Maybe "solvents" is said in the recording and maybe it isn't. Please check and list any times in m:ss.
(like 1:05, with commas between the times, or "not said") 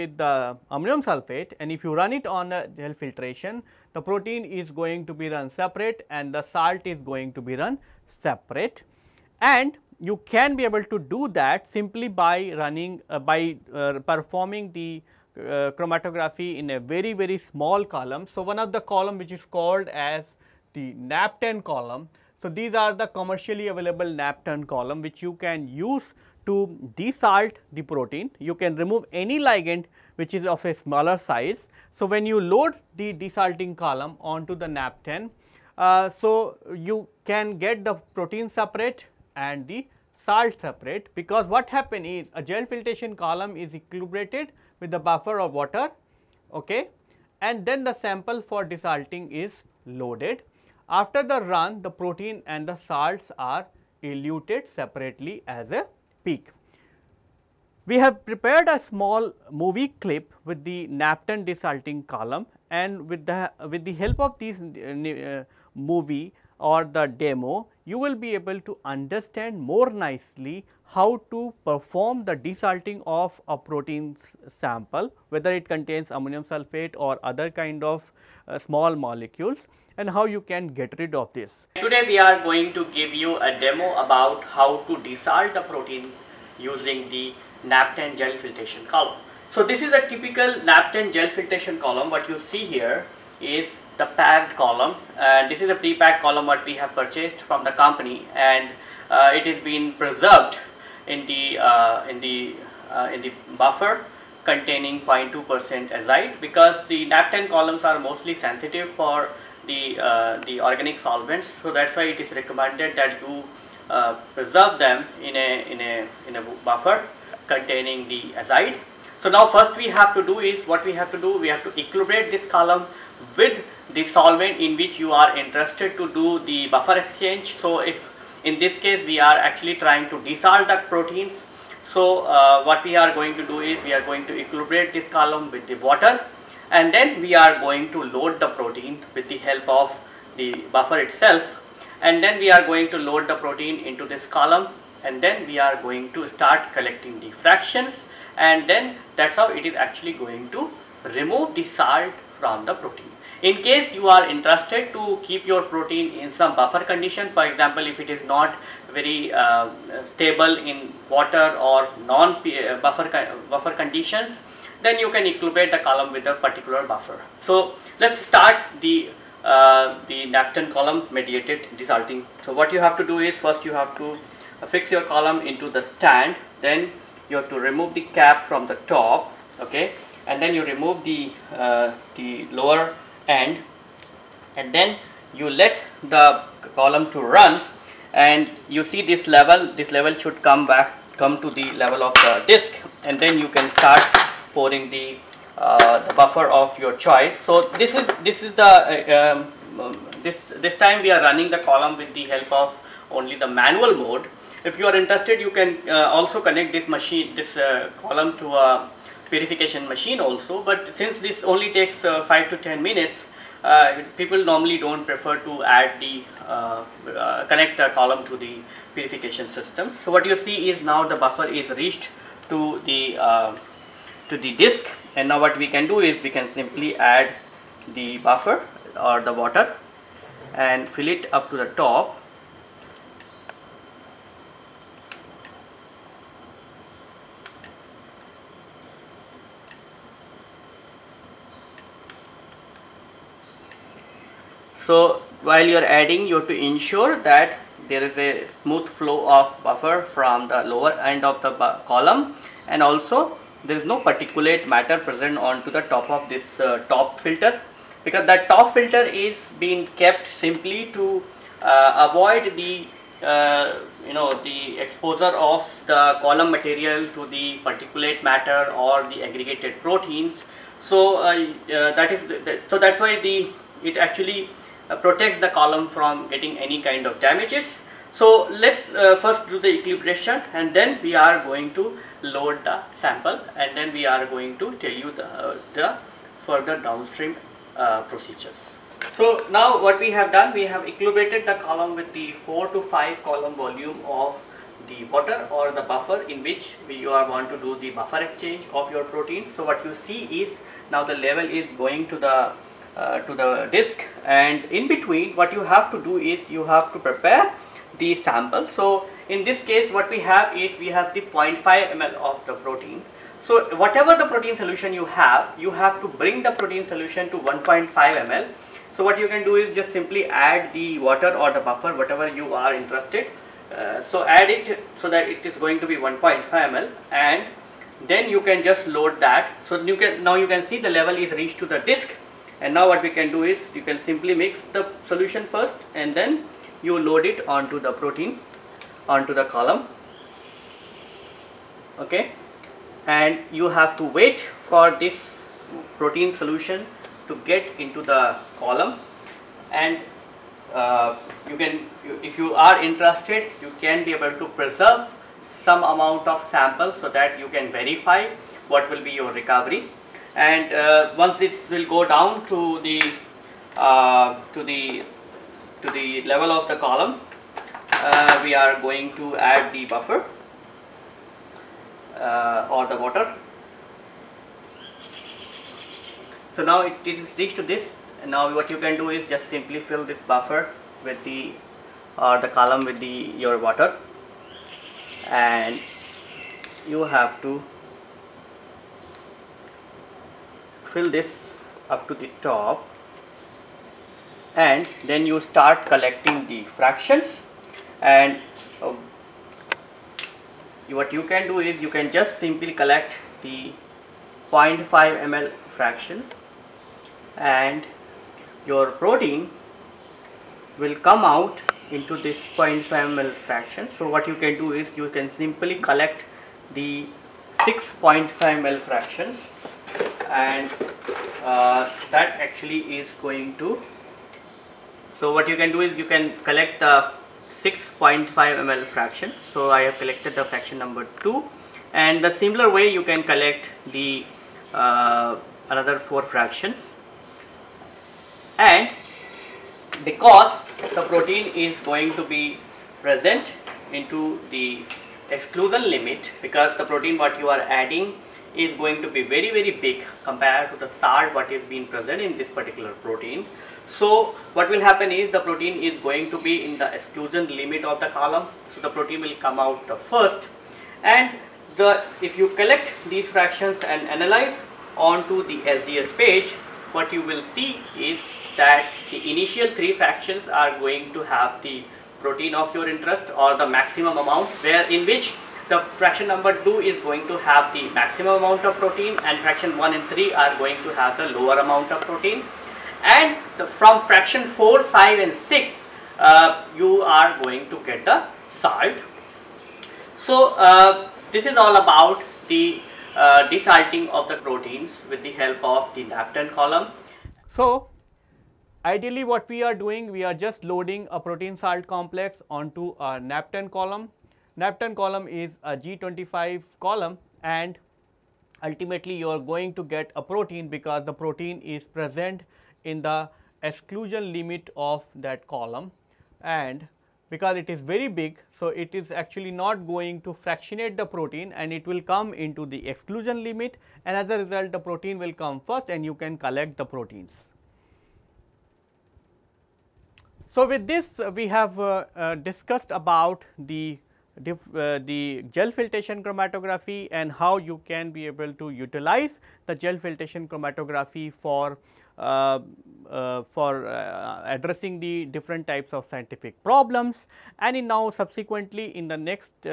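1:50, 2:04.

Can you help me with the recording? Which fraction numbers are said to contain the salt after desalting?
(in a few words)
4, 5 and 6.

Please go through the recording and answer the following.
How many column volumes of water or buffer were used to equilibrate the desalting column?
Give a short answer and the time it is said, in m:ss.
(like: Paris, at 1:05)
4 to 5, at 4:52.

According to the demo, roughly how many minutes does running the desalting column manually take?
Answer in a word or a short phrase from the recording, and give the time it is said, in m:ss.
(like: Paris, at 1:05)
5 to 10 minutes, at 3:32.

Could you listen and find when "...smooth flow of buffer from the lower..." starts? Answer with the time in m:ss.
4:08.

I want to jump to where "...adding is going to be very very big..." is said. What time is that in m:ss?
7:27.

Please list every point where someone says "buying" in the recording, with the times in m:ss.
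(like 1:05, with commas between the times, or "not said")
not said.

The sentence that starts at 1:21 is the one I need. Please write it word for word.
Today we are going to give you a demo about how to desalt a protein using the NAP-10 gel filtration column.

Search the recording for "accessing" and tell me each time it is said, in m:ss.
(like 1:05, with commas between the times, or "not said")
not said.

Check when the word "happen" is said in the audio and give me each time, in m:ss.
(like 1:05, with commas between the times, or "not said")
0:41, 7:34.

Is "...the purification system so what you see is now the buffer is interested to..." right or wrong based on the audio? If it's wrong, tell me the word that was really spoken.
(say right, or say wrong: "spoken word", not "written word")
wrong: "reached", not "interested".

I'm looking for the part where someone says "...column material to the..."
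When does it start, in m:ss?
4:26.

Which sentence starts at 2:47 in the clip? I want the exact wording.
So let's start the uh, the NAP-10 column mediated desalting.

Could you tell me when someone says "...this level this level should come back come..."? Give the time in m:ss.
3:09.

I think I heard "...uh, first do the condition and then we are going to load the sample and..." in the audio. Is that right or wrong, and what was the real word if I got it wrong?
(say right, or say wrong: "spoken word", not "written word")
wrong: "equilibration", not "condition".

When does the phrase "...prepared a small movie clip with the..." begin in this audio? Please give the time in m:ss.
0:58.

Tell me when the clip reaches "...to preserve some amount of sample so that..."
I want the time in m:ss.
5:54.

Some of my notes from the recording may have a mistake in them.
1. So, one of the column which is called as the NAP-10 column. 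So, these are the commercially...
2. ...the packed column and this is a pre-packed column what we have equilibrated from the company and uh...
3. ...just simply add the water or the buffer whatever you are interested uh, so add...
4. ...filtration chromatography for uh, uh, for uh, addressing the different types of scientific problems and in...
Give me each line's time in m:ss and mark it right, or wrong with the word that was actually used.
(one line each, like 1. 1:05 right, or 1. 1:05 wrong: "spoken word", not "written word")
1. 0:18 right
2. 1:33 wrong: "purchased", not "equilibrated"
3. 5:19 right
4. 8:59 right.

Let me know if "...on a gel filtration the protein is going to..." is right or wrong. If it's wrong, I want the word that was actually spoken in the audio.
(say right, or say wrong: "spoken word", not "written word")
right.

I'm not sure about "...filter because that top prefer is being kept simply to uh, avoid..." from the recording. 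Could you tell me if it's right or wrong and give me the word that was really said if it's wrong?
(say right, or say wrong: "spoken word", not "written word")
wrong: "filter", not "prefer".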